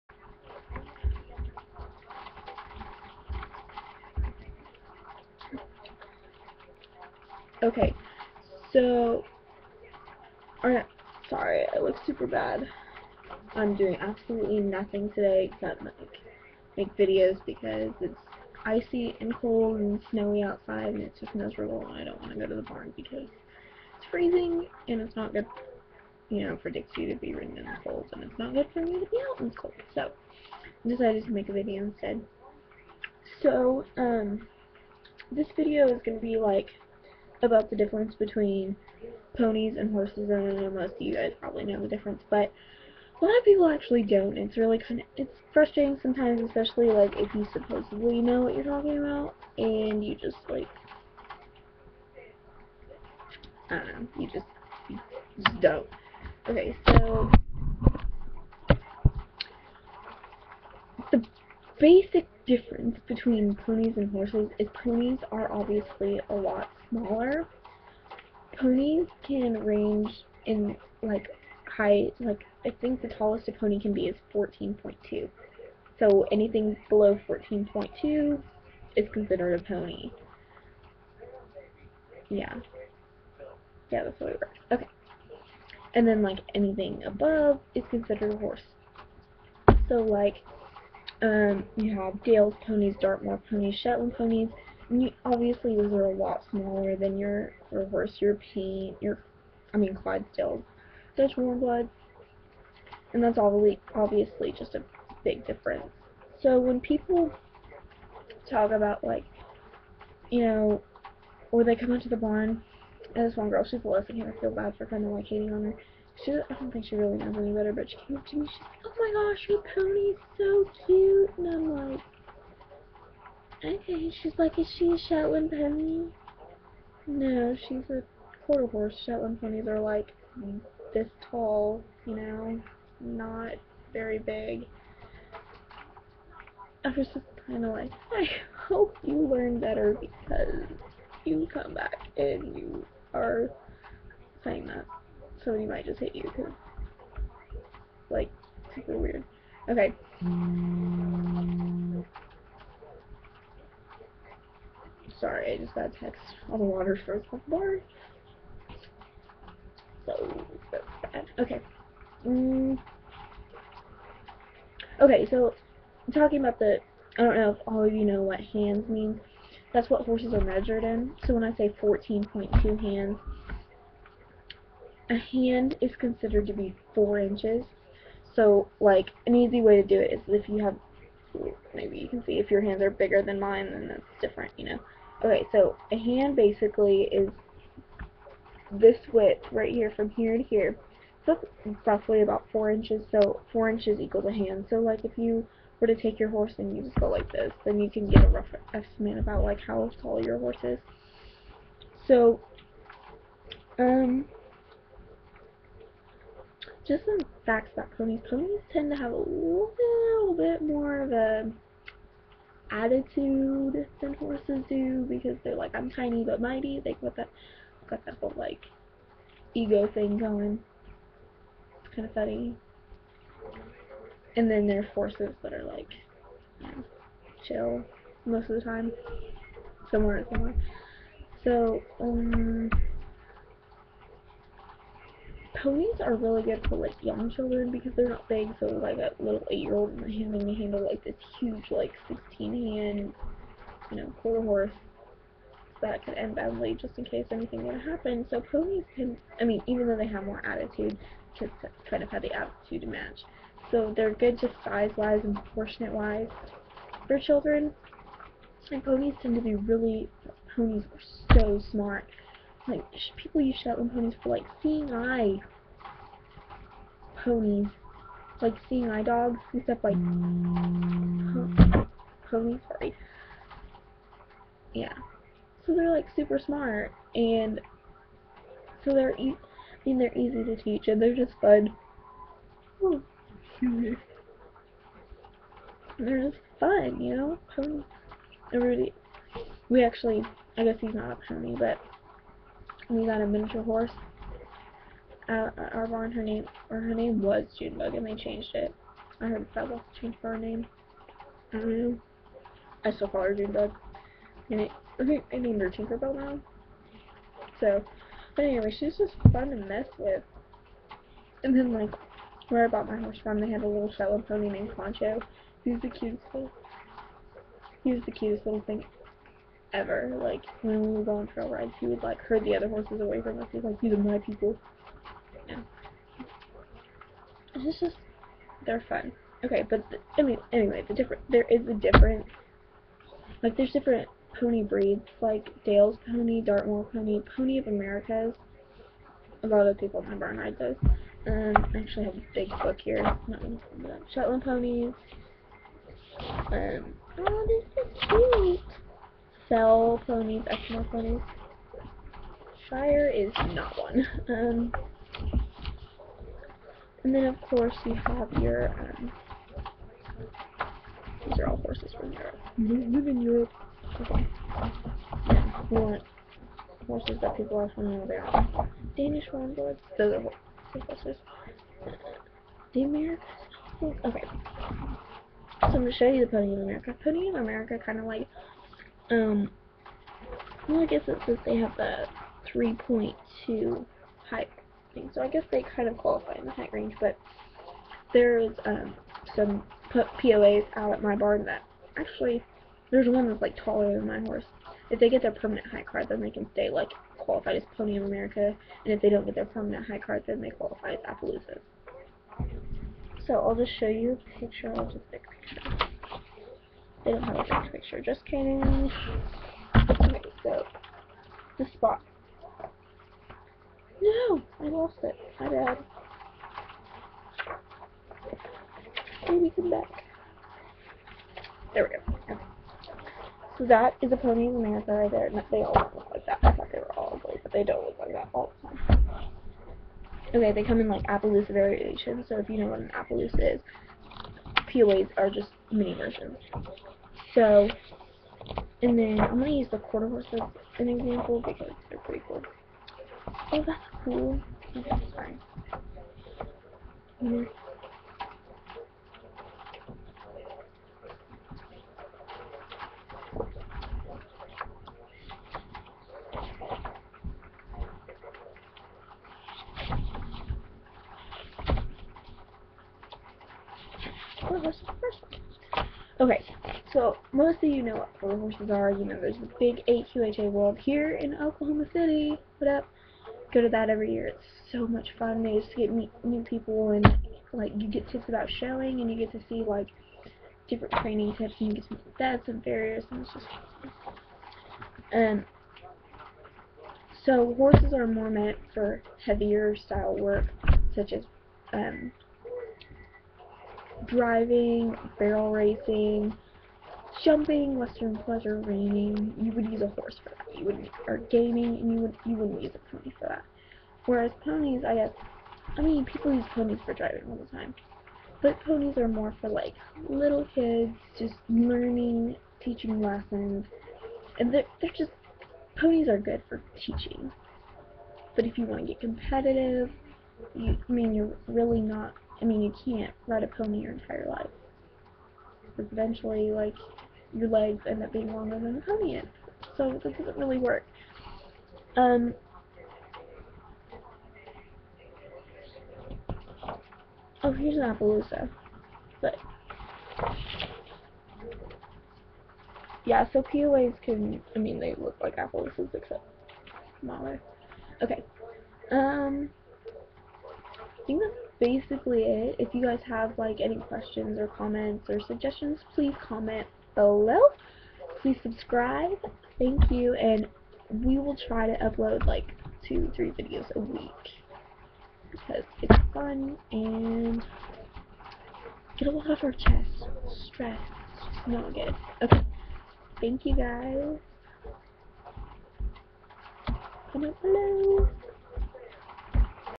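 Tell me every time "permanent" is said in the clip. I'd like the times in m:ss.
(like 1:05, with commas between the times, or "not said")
6:35, 6:39.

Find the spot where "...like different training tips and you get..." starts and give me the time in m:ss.
7:59.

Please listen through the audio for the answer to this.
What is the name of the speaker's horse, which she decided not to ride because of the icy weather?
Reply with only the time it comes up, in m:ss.
0:26.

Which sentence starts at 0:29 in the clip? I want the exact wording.
So I decided to make a video instead.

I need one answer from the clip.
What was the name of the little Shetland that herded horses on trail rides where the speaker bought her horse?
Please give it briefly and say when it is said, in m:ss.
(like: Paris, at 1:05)
Concho, at 5:14.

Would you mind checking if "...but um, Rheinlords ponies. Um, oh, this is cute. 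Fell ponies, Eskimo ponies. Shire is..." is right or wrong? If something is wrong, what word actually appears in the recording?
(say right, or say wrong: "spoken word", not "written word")
wrong: "Shetland", not "Rheinlords".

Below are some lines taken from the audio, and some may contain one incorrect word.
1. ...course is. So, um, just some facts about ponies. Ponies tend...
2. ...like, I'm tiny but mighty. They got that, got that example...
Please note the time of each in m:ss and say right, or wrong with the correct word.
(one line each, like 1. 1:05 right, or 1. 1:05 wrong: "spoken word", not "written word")
1. 3:20 wrong: "horse", not "course"
2. 3:35 wrong: "whole", not "example".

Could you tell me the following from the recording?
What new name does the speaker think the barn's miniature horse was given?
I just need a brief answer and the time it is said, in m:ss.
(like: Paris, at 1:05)
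Tinkerbell, at 5:05.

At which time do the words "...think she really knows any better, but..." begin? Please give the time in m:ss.
1:56.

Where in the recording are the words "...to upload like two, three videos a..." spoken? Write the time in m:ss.
9:21.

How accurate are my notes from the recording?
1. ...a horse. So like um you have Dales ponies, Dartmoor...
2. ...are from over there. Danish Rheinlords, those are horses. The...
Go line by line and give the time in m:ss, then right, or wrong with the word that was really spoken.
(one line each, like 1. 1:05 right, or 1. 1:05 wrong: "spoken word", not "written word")
1. 1:28 right
2. 6:07 right.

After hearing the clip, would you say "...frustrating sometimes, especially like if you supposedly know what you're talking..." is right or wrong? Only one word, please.
right.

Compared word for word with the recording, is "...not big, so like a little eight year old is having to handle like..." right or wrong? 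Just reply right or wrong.
right.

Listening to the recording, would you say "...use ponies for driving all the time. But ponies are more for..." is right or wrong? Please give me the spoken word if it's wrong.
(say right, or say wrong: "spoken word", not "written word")
right.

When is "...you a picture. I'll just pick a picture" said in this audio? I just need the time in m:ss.
6:43.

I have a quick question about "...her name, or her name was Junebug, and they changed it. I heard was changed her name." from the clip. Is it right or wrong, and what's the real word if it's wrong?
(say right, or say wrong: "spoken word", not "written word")
right.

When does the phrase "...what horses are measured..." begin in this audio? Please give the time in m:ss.
2:49.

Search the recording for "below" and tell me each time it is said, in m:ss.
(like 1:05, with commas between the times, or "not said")
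1:16, 9:16, 9:37.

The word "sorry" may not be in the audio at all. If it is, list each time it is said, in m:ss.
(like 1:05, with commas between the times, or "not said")
0:11, 2:35, 4:32.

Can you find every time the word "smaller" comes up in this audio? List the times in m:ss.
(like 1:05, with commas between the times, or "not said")
1:06, 1:36, 9:07.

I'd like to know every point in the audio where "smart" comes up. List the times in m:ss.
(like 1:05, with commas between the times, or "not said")
4:21, 4:36.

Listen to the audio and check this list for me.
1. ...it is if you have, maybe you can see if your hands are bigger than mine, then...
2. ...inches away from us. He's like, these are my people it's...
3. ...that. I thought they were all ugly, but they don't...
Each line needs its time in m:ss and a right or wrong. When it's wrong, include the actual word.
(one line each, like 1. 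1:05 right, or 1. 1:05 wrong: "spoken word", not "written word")
1. 2:59 right
2. 5:22 wrong: "horses", not "inches"
3. 7:06 right.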